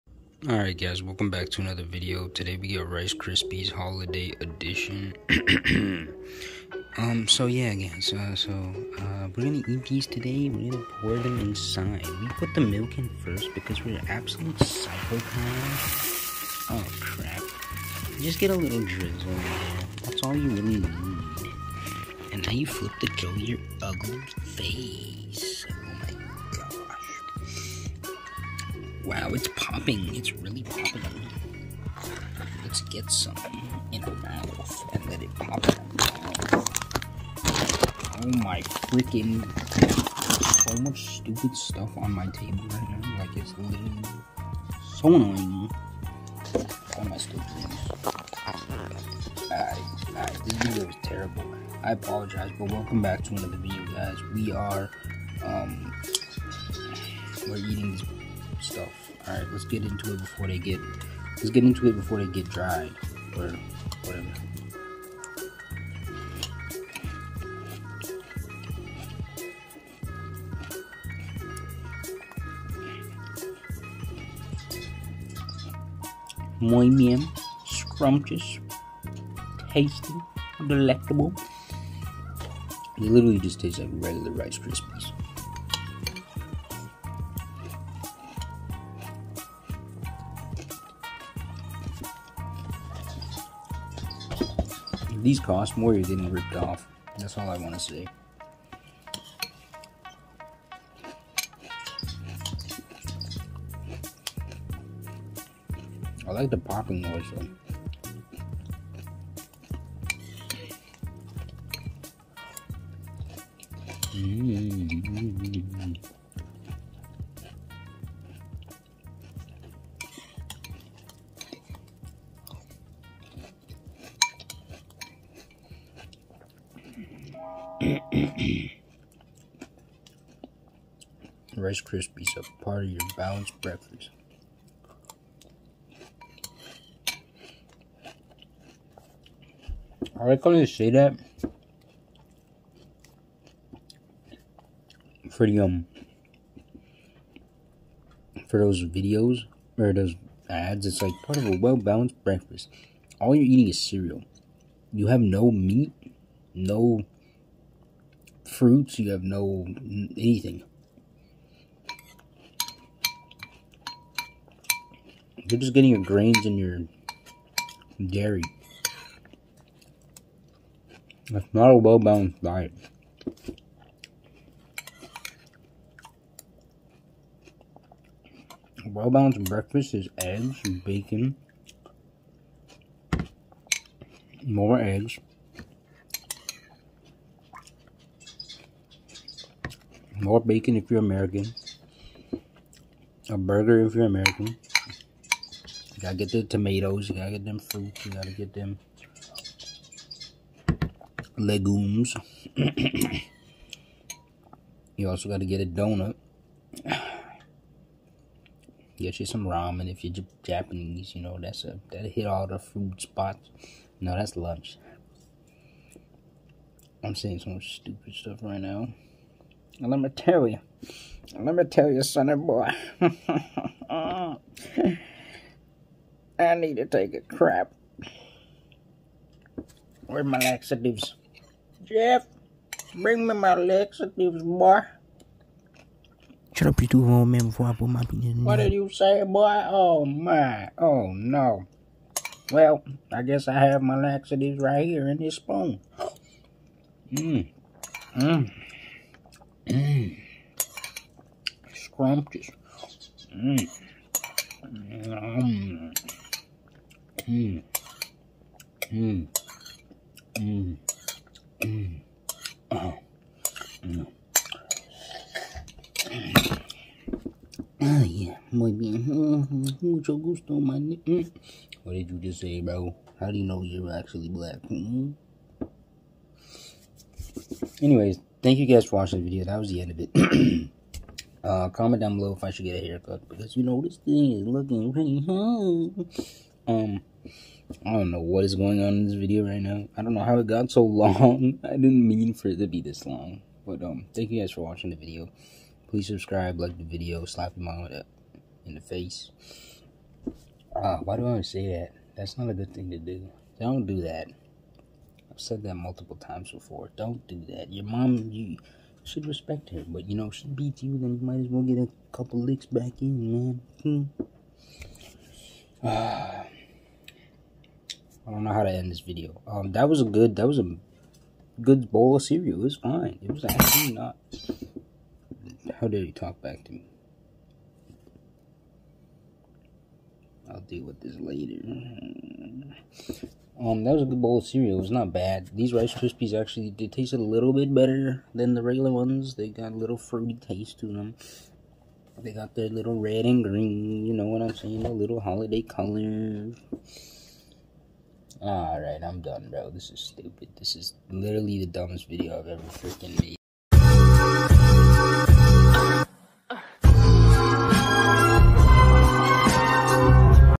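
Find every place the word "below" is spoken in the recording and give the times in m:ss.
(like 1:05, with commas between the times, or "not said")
4:42.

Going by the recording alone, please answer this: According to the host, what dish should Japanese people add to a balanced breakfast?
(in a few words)
Ramen.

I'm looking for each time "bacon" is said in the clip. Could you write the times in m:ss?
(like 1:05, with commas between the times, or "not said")
3:00, 3:10.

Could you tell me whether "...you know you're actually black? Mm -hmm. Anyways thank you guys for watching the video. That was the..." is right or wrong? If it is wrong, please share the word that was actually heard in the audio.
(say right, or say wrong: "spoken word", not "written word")
right.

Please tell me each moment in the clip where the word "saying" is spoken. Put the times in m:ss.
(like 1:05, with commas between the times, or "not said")
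3:37, 5:44.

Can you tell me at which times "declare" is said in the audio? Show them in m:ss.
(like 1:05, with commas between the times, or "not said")
not said.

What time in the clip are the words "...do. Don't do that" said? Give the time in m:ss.
5:02.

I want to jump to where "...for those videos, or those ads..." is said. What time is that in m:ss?
2:28.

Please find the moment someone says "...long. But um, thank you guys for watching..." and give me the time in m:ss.
4:53.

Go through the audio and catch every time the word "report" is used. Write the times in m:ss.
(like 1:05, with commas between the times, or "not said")
not said.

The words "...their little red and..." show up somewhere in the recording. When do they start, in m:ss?
5:42.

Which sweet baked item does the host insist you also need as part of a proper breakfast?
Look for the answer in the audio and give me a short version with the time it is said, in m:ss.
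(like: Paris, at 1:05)
A donut, at 3:25.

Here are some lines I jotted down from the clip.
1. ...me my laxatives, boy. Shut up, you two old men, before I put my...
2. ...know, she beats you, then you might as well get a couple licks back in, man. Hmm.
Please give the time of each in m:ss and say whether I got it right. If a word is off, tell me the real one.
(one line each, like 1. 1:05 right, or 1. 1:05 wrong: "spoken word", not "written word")
1. 3:53 right
2. 5:10 right.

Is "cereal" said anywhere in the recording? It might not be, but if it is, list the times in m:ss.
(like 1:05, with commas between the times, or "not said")
2:33, 5:22, 5:34.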